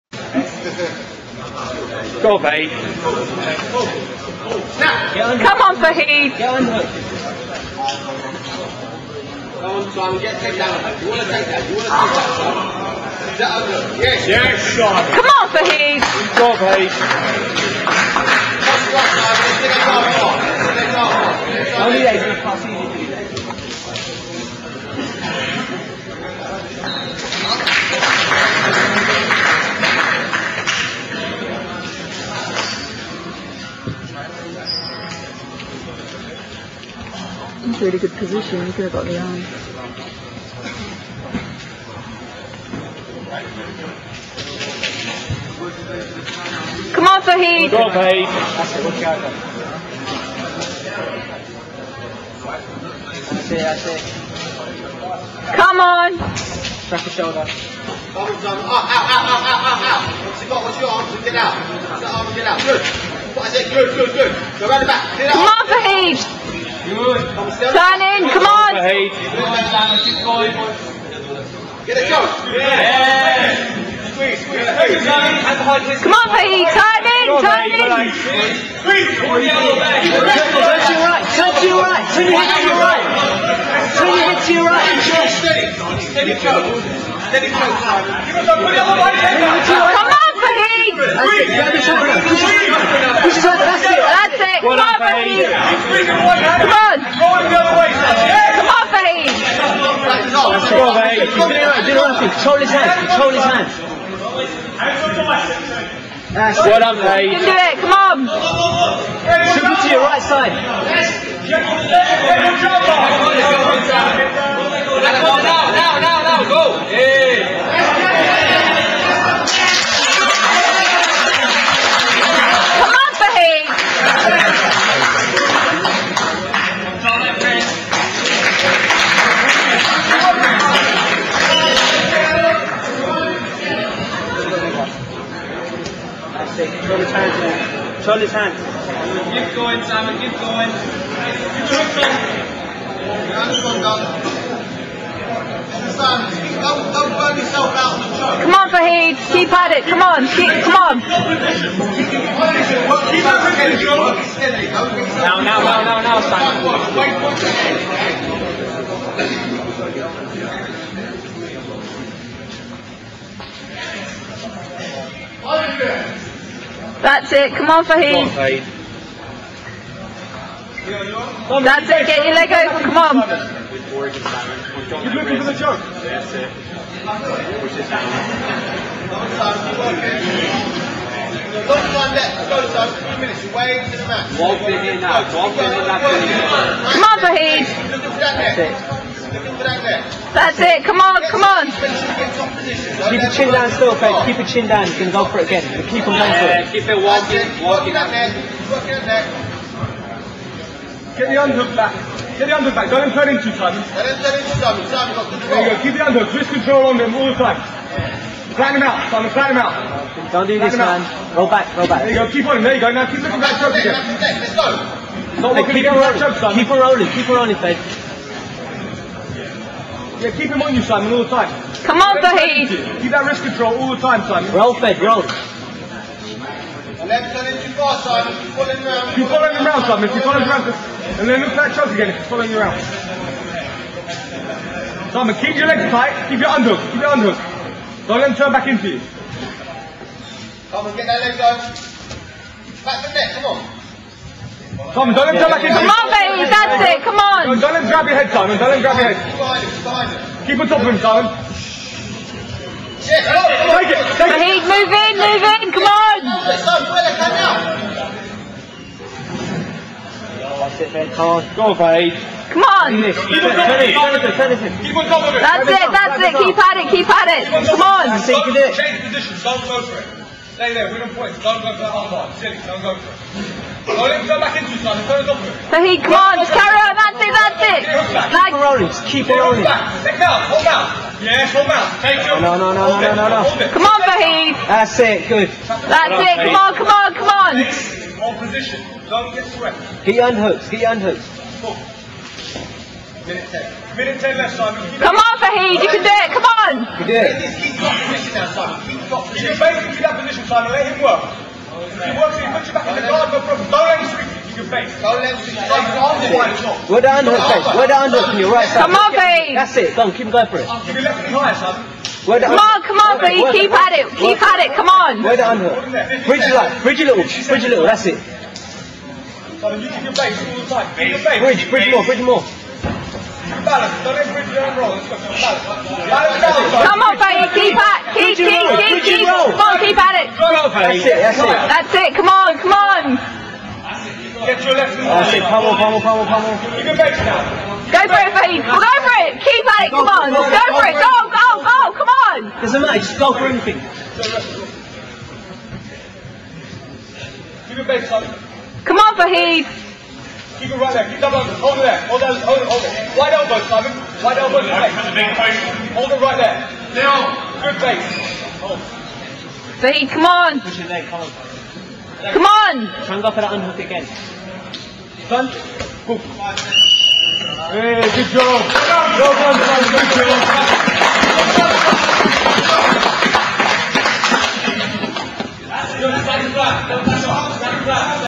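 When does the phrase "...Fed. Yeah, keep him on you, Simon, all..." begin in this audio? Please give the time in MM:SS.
03:37.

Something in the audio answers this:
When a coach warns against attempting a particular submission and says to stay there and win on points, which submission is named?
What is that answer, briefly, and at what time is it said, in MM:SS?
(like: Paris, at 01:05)
Armbar, at 04:31.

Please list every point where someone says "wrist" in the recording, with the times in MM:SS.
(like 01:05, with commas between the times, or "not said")
03:43.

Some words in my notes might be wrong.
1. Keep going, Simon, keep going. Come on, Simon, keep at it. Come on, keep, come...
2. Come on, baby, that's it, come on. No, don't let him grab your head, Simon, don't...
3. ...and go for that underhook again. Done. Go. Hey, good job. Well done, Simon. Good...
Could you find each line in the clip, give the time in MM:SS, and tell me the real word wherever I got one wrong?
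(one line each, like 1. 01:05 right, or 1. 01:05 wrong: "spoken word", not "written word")
1. 02:19 wrong: "Fahed", not "Simon"
2. 04:05 right
3. 06:03 right.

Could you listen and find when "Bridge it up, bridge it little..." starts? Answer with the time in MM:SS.
05:16.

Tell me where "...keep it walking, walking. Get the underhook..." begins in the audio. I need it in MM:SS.
03:16.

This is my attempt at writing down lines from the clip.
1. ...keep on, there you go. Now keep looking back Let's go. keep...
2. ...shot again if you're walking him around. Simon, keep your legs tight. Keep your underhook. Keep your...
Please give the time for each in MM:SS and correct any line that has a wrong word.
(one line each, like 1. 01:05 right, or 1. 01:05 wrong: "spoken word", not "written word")
1. 03:32 right
2. 03:51 wrong: "following", not "walking".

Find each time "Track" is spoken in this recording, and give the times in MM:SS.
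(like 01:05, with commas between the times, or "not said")
00:56.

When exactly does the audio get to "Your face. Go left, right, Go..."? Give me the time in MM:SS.
05:04.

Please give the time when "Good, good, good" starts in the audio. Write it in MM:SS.
01:03.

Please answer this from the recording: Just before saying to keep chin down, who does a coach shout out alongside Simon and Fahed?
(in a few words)
Oliver.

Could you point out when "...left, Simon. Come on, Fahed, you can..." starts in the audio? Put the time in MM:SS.
04:54.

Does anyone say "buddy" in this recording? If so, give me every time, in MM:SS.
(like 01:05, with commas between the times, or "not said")
05:13.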